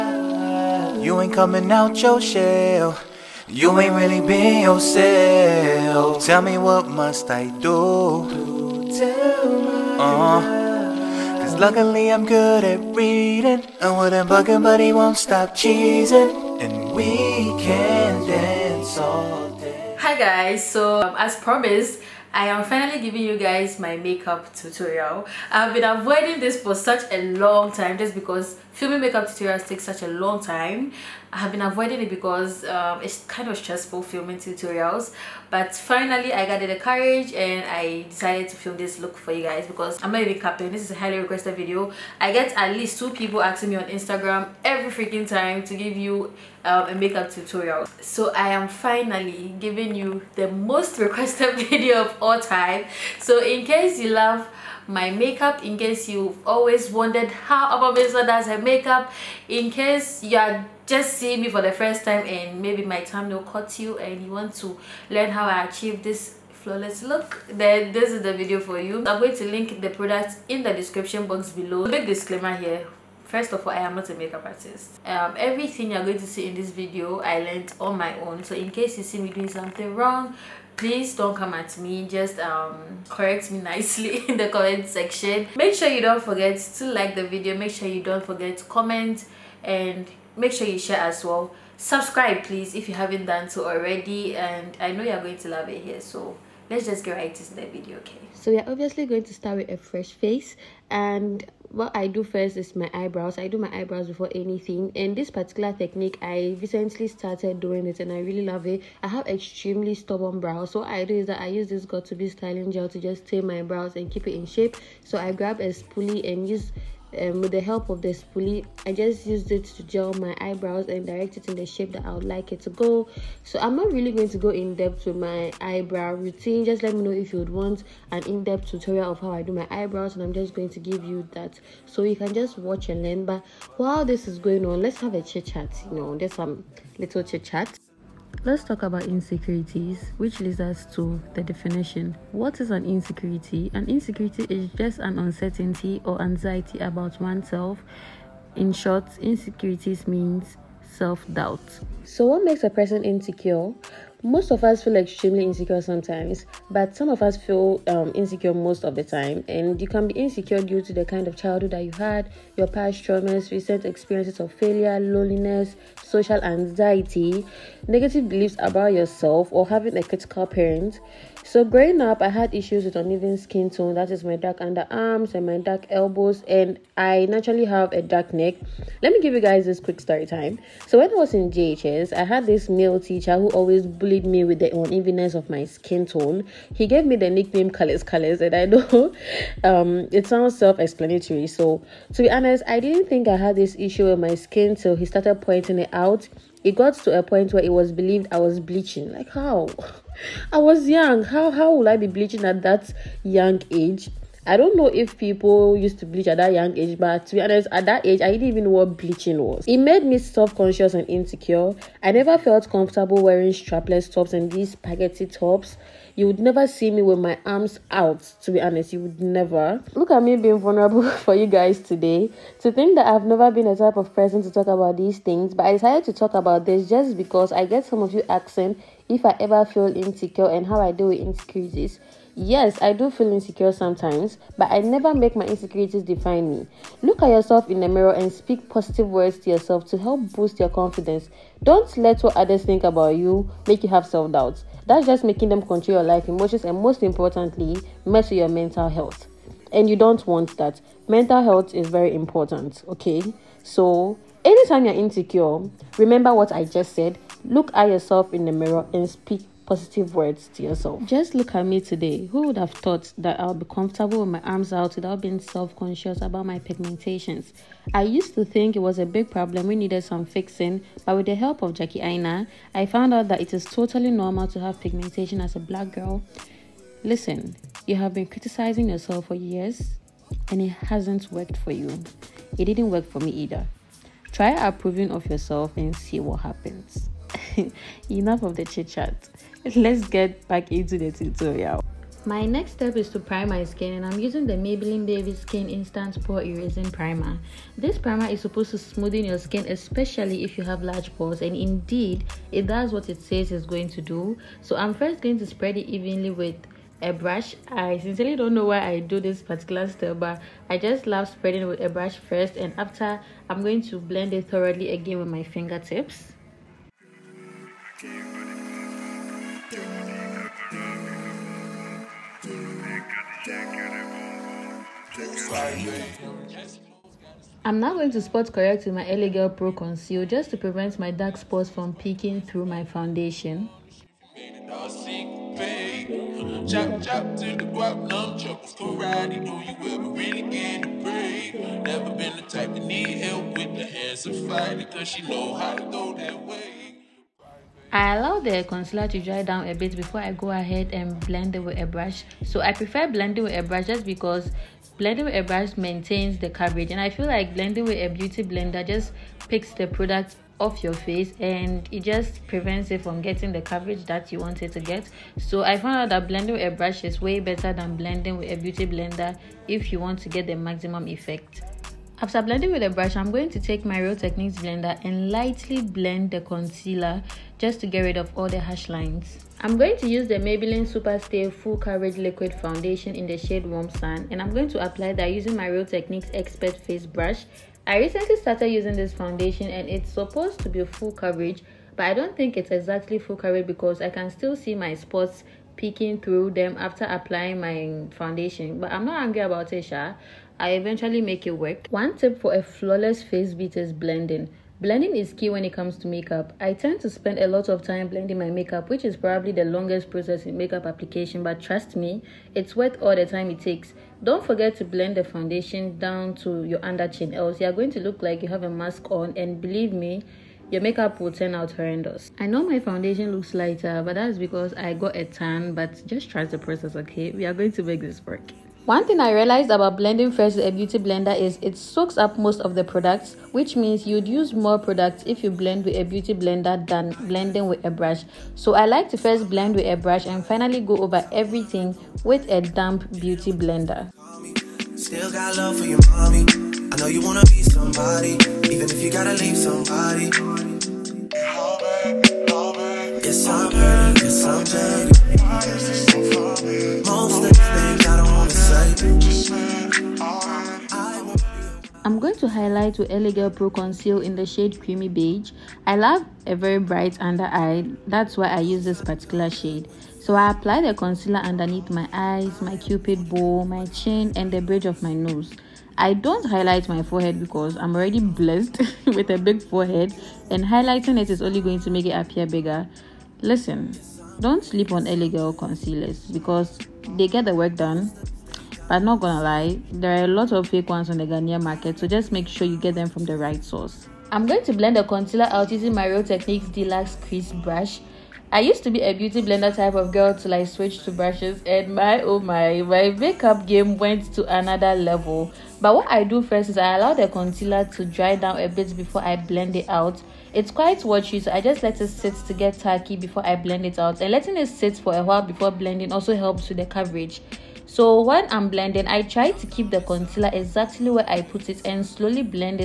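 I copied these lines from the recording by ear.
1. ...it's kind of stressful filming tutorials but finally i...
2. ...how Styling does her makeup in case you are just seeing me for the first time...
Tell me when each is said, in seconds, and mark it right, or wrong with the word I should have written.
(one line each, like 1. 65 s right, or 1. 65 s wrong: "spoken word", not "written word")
1. 33 s right
2. 57 s wrong: "Ama", not "Styling".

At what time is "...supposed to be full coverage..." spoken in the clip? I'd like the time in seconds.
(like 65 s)
390 s.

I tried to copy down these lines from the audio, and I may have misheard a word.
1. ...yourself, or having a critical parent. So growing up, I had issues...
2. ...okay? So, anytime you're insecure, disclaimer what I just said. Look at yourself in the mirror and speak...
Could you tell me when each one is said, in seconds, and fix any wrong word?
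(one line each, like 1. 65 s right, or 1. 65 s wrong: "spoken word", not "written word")
1. 168 s right
2. 252 s wrong: "remember", not "disclaimer".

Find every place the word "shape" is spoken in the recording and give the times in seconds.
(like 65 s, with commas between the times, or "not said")
114 s, 121 s.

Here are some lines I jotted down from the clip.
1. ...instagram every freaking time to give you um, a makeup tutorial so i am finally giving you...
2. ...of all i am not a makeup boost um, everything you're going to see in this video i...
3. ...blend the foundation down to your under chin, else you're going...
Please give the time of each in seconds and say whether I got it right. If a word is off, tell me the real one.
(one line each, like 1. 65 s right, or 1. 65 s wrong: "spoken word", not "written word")
1. 43 s right
2. 73 s wrong: "artist", not "boost"
3. 414 s right.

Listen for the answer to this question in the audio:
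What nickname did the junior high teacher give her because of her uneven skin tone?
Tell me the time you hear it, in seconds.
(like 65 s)
187 s.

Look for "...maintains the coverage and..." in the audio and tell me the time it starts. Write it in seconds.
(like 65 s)
355 s.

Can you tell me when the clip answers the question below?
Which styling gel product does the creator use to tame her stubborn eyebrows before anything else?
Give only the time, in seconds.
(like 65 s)
111 s.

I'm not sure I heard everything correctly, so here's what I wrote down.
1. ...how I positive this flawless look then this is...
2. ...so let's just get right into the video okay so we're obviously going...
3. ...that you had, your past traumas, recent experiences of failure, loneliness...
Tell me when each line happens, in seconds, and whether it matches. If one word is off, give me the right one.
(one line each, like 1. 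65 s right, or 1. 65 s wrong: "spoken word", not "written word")
1. 65 s wrong: "achieve", not "positive"
2. 96 s right
3. 161 s right.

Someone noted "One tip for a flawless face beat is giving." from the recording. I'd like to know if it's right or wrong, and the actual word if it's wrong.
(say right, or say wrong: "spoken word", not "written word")
wrong: "blending", not "giving".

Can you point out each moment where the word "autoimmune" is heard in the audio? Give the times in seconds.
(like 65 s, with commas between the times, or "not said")
not said.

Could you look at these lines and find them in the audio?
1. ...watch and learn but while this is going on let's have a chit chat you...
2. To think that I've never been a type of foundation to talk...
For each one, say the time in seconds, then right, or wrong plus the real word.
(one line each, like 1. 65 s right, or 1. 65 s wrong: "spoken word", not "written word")
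1. 132 s right
2. 222 s wrong: "person", not "foundation".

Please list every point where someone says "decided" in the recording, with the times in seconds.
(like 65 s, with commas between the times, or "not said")
38 s, 225 s.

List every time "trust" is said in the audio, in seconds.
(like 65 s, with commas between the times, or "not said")
411 s, 426 s.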